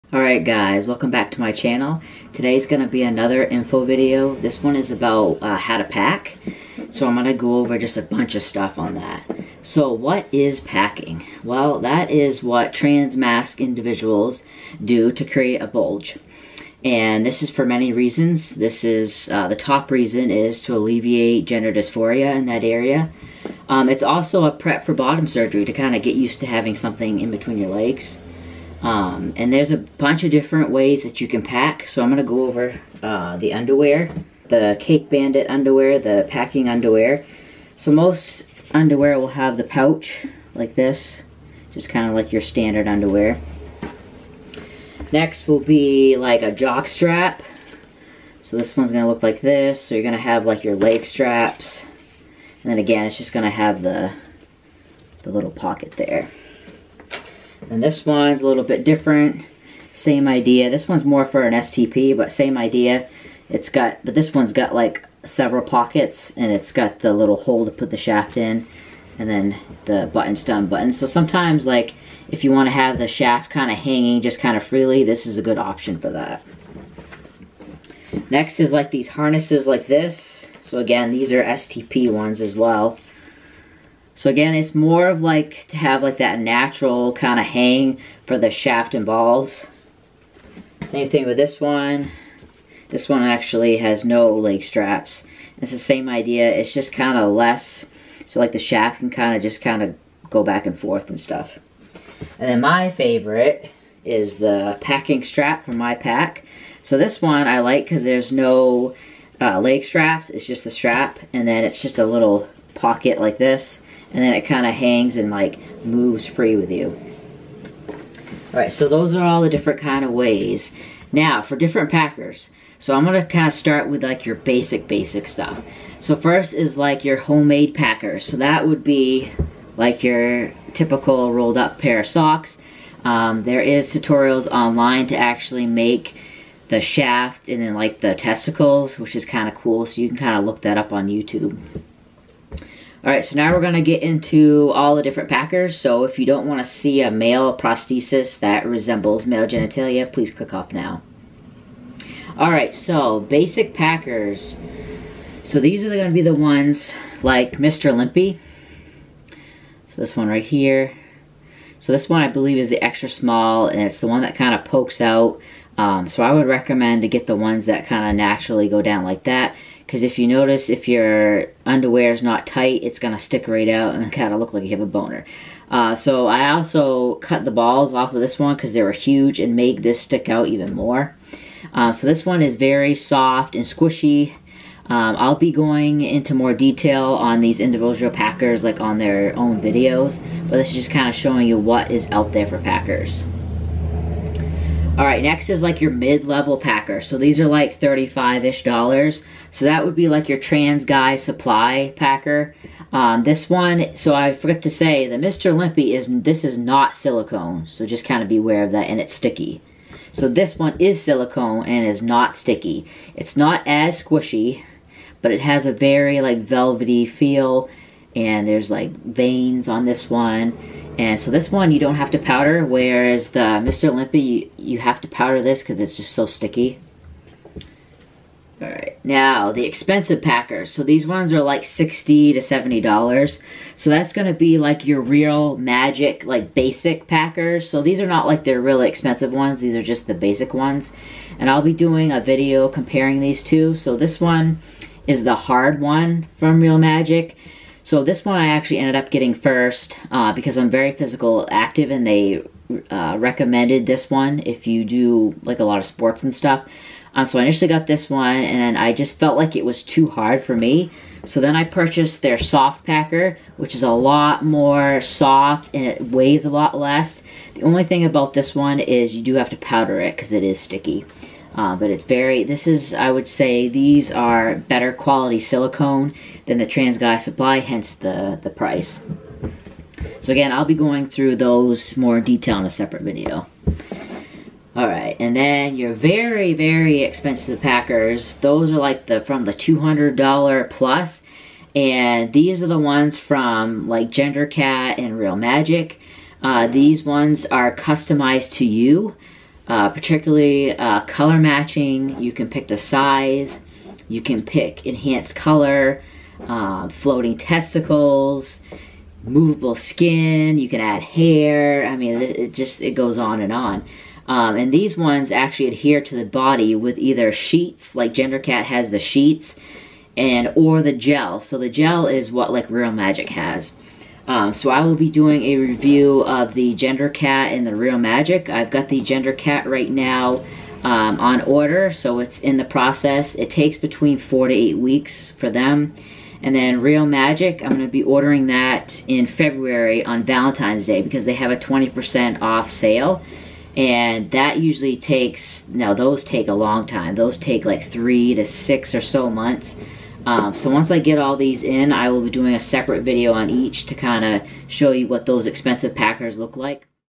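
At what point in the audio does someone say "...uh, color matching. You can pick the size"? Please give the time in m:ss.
5:00.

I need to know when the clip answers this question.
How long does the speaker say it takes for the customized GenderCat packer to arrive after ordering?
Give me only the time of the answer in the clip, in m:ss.
5:34.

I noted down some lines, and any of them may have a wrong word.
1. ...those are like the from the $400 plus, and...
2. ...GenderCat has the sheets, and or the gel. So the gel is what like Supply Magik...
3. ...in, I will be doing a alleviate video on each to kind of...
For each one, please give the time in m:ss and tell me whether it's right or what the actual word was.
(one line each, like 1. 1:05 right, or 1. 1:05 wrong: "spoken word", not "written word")
1. 4:48 wrong: "200", not "400"
2. 5:18 wrong: "Reel", not "Supply"
3. 5:51 wrong: "separate", not "alleviate".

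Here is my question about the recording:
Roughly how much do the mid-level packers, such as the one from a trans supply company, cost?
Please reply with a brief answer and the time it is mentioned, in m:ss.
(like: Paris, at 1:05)
$35, at 3:17.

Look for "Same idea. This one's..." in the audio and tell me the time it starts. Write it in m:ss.
0:59.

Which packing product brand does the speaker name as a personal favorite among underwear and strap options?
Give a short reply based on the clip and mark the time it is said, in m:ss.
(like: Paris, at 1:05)
My Pack, at 1:45.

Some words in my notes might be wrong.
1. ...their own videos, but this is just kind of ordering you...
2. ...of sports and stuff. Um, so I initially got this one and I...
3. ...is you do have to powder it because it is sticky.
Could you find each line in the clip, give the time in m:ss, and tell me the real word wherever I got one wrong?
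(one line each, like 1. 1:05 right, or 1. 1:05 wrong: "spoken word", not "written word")
1. 3:08 wrong: "showing", not "ordering"
2. 4:15 right
3. 4:28 right.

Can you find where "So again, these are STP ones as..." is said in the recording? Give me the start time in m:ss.
1:20.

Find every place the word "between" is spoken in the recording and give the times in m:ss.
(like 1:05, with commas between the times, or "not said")
0:27, 5:33.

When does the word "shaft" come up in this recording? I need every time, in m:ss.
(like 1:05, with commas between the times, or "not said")
1:07, 1:13, 1:28, 1:38, 2:16.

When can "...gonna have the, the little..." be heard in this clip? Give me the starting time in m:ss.
0:53.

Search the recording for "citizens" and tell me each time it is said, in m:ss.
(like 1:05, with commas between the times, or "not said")
not said.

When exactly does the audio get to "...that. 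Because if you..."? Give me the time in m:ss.
2:49.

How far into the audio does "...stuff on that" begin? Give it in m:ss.
0:08.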